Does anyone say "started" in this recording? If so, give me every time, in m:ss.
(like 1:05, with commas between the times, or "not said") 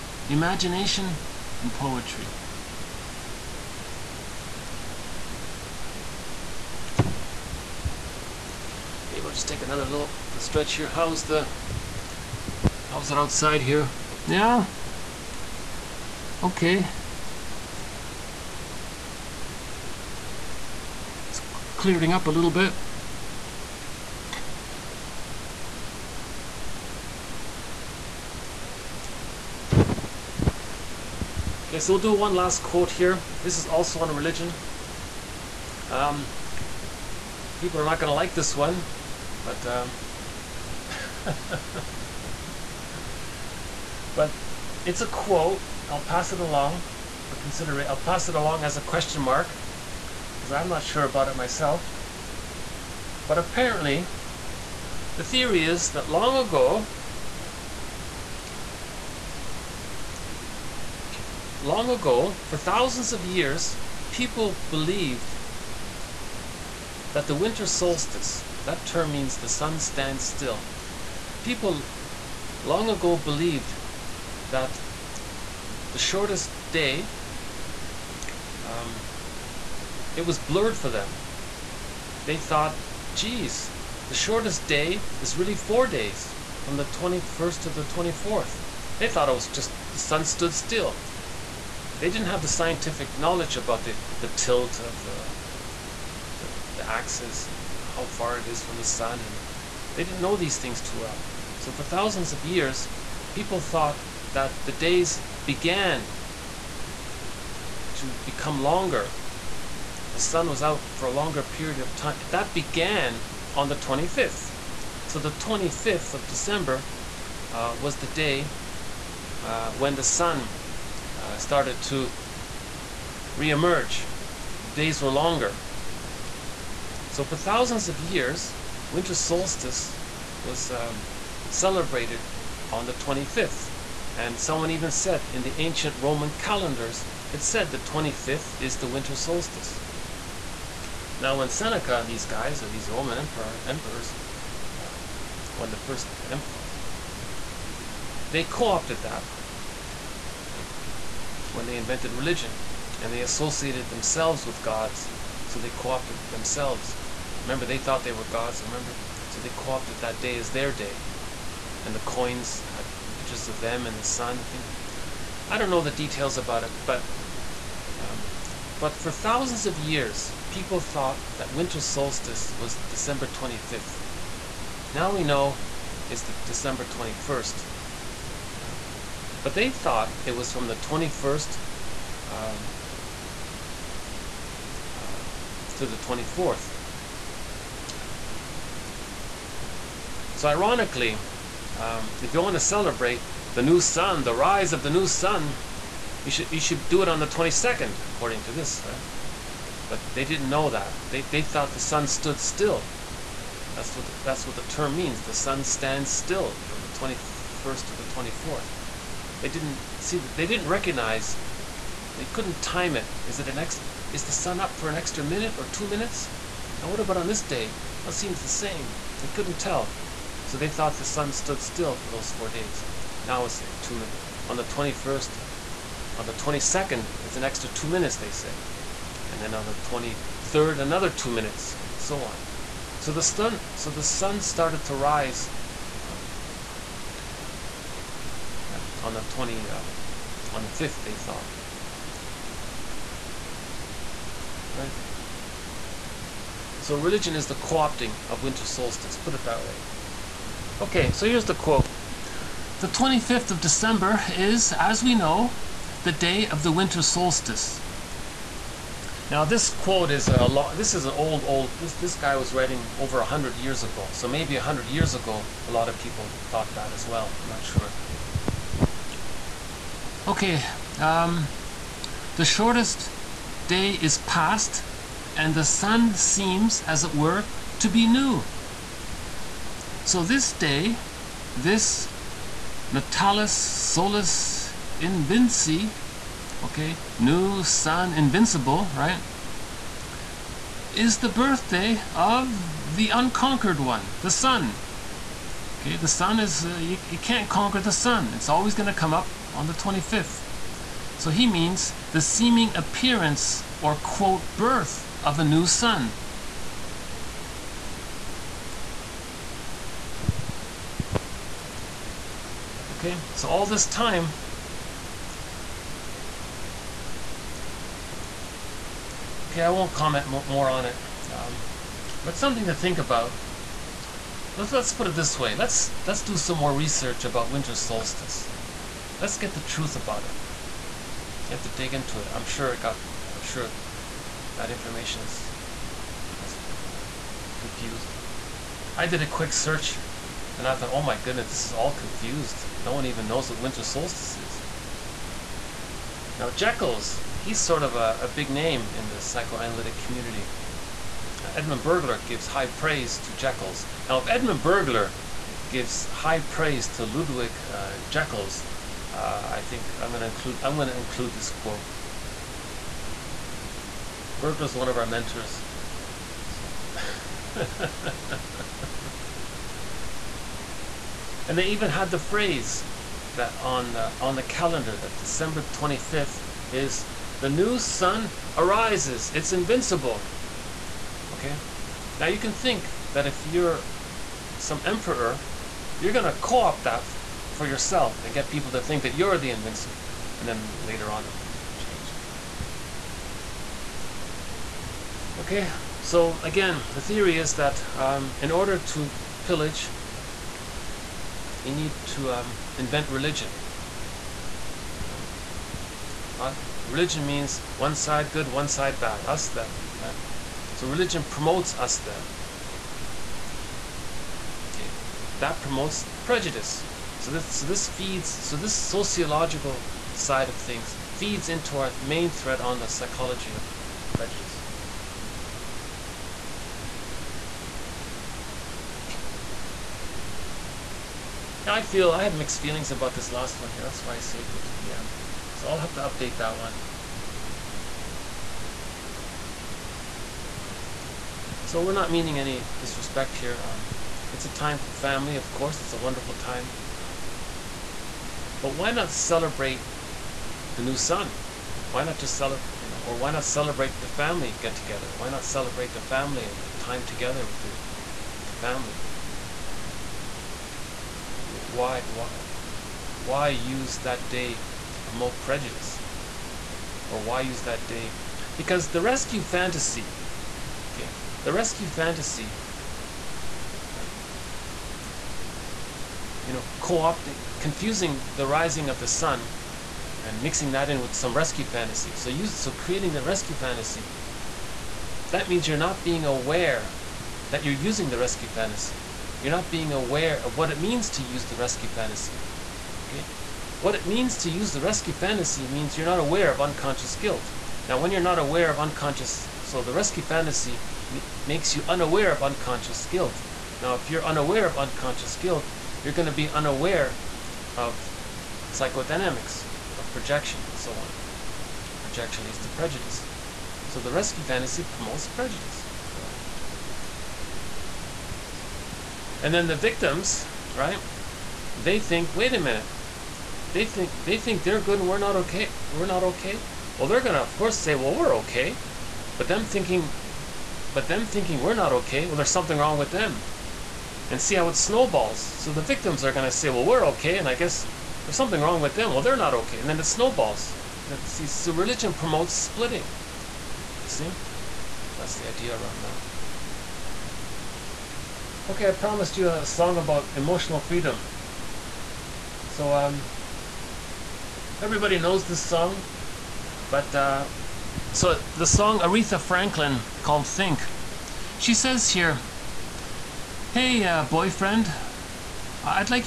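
2:01, 3:54.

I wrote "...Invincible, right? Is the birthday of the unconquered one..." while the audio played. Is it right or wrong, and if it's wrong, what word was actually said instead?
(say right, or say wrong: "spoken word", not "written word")
right.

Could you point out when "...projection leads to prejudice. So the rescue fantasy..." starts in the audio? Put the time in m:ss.
8:32.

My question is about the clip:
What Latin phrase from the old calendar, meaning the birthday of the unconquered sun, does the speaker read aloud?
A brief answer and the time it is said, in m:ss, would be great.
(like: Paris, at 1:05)
Natalis Solis Invinci, at 4:42.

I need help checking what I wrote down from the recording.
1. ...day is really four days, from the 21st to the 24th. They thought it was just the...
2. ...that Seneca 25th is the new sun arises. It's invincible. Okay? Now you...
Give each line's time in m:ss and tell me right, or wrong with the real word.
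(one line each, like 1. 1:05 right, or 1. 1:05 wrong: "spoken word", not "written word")
1. 1:24 right
2. 6:14 wrong: "December", not "Seneca".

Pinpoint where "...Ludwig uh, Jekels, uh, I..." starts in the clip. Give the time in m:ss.
5:57.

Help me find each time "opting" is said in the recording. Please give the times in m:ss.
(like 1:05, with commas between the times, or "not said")
4:07, 7:56.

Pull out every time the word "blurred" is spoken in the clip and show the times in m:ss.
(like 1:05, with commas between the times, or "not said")
1:20.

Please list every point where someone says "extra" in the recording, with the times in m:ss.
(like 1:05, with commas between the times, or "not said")
3:34, 3:47.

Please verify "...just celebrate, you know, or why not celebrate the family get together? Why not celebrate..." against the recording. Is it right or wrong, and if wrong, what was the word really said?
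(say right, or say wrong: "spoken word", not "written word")
right.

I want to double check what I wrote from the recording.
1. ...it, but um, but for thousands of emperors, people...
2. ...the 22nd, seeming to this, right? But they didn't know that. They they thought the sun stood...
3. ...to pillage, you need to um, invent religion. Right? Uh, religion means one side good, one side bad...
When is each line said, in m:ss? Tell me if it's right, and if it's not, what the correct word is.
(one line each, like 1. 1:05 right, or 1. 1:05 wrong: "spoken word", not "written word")
1. 2:46 wrong: "years", not "emperors"
2. 3:17 wrong: "according", not "seeming"
3. 6:38 right.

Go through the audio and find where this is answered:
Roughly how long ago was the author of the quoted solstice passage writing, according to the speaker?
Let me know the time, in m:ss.
4:22.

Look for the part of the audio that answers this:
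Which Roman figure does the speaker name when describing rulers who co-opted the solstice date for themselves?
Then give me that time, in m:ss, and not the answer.
2:21.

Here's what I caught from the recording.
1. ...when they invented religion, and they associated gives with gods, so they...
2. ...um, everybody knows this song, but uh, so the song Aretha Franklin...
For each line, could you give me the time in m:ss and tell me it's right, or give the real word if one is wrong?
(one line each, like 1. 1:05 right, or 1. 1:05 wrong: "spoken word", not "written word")
1. 2:31 wrong: "themselves", not "gives"
2. 9:12 right.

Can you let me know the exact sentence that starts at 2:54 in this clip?
Now we know it's the December 21st.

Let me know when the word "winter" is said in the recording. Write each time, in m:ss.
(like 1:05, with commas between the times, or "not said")
1:07, 2:08, 2:18, 2:51, 4:08, 4:16, 5:27, 5:43.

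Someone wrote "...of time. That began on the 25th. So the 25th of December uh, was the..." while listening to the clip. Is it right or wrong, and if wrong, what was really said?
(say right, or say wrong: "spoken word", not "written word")
right.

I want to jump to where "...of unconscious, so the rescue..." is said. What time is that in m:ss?
8:18.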